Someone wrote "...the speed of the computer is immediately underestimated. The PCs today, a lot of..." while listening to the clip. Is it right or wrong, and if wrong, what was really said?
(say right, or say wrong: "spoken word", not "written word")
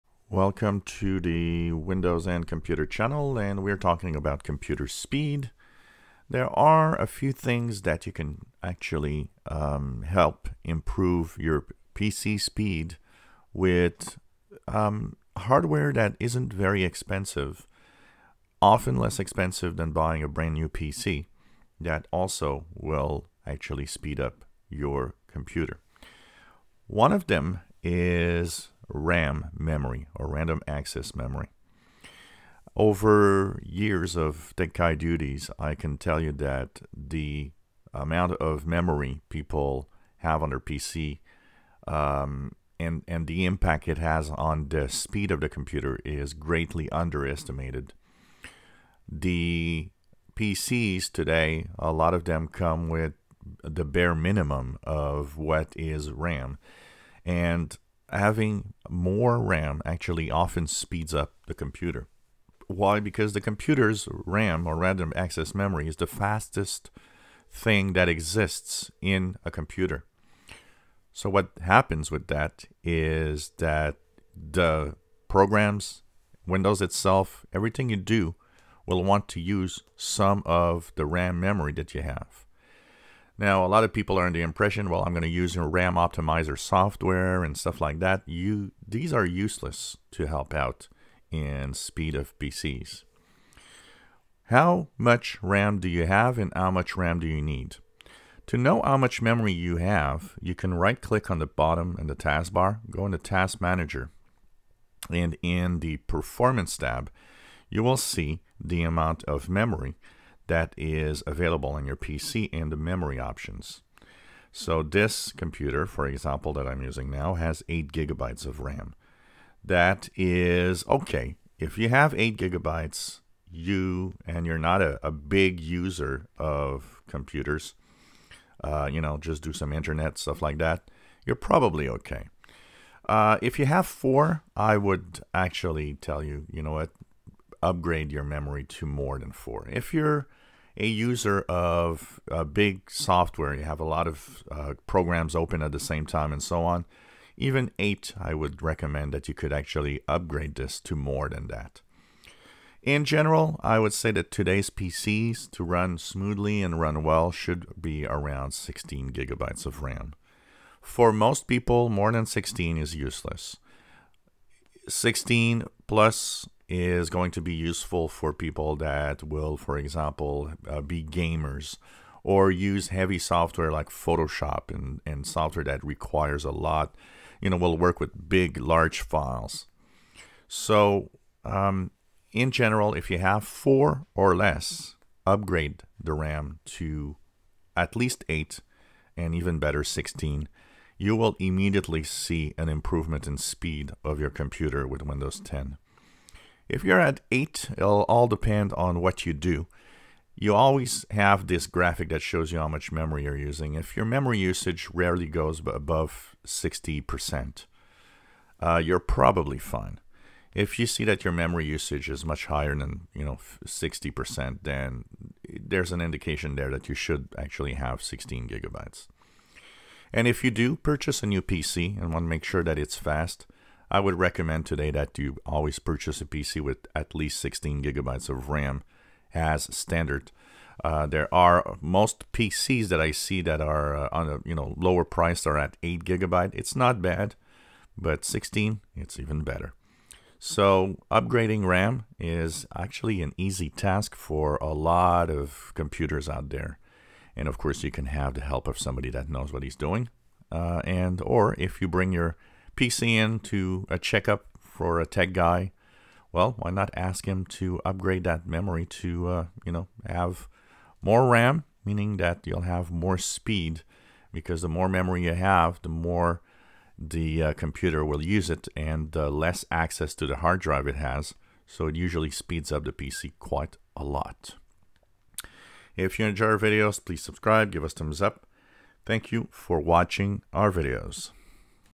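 wrong: "greatly", not "immediately".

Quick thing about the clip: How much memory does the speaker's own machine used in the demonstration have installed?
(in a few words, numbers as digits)
8 gigabytes.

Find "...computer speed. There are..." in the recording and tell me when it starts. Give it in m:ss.
0:04.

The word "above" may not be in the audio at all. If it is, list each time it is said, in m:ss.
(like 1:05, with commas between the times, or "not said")
3:25.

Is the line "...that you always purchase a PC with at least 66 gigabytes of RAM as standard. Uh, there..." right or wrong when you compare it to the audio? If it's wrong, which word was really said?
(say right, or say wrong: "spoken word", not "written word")
wrong: "16", not "66".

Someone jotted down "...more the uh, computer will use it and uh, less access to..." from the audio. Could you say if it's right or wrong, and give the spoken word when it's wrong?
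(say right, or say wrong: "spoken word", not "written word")
right.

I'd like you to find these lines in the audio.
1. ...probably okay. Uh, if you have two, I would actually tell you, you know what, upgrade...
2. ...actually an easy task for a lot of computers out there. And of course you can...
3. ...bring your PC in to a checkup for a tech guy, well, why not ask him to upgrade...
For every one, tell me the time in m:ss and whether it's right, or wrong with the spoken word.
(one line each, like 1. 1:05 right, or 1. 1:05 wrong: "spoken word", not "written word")
1. 2:11 wrong: "four", not "two"
2. 4:02 right
3. 4:11 right.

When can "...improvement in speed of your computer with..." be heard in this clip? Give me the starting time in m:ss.
3:12.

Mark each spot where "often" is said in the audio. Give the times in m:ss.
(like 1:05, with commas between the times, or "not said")
0:18, 1:00.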